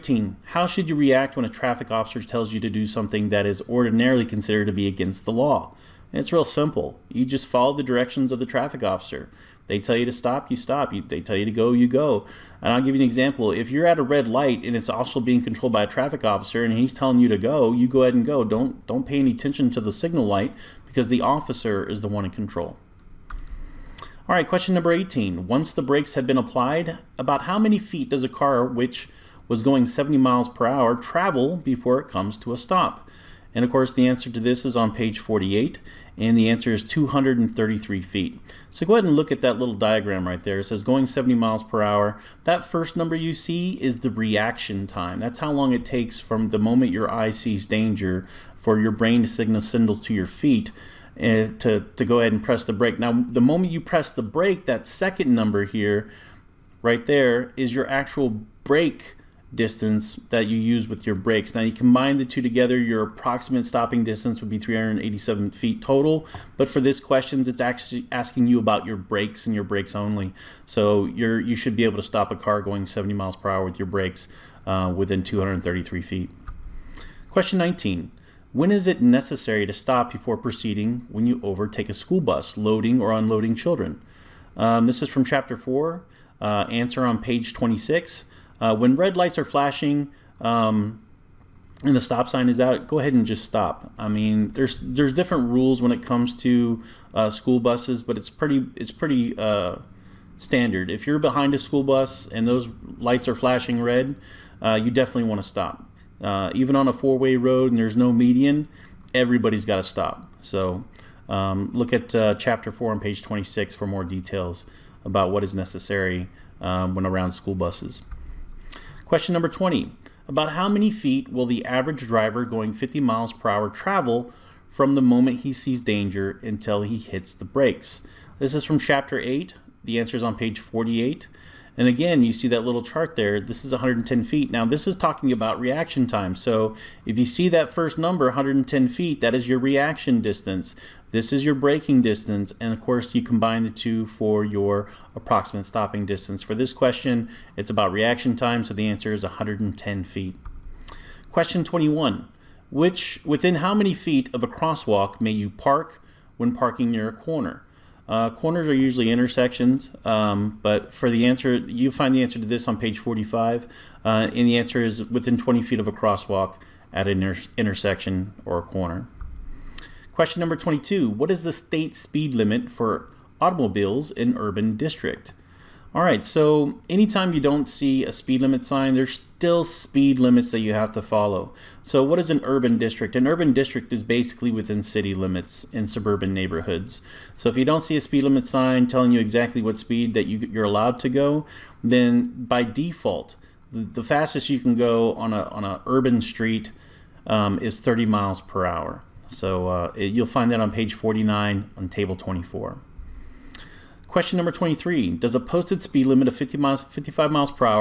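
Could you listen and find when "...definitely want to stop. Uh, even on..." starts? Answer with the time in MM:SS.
01:44.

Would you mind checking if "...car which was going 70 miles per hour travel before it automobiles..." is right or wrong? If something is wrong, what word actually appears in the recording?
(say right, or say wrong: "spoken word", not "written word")
wrong: "comes", not "automobiles".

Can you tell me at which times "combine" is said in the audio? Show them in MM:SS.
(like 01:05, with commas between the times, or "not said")
01:01, 02:23.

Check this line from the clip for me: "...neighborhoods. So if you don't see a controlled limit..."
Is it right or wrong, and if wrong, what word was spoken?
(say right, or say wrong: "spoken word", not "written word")
wrong: "speed", not "controlled".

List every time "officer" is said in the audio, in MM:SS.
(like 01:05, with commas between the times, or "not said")
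00:01, 00:08, 00:16, 00:21.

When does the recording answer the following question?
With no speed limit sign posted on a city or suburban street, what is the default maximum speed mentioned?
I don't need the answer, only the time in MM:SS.
03:17.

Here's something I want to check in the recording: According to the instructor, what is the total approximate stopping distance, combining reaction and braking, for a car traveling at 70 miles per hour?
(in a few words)
387 feet.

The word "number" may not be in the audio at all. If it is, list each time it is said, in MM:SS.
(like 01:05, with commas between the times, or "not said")
00:24, 00:42, 00:55, 01:59, 02:17, 02:50, 03:24.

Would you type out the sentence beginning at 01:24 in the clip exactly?
Um, this is from chapter 4, uh, answer on page 26.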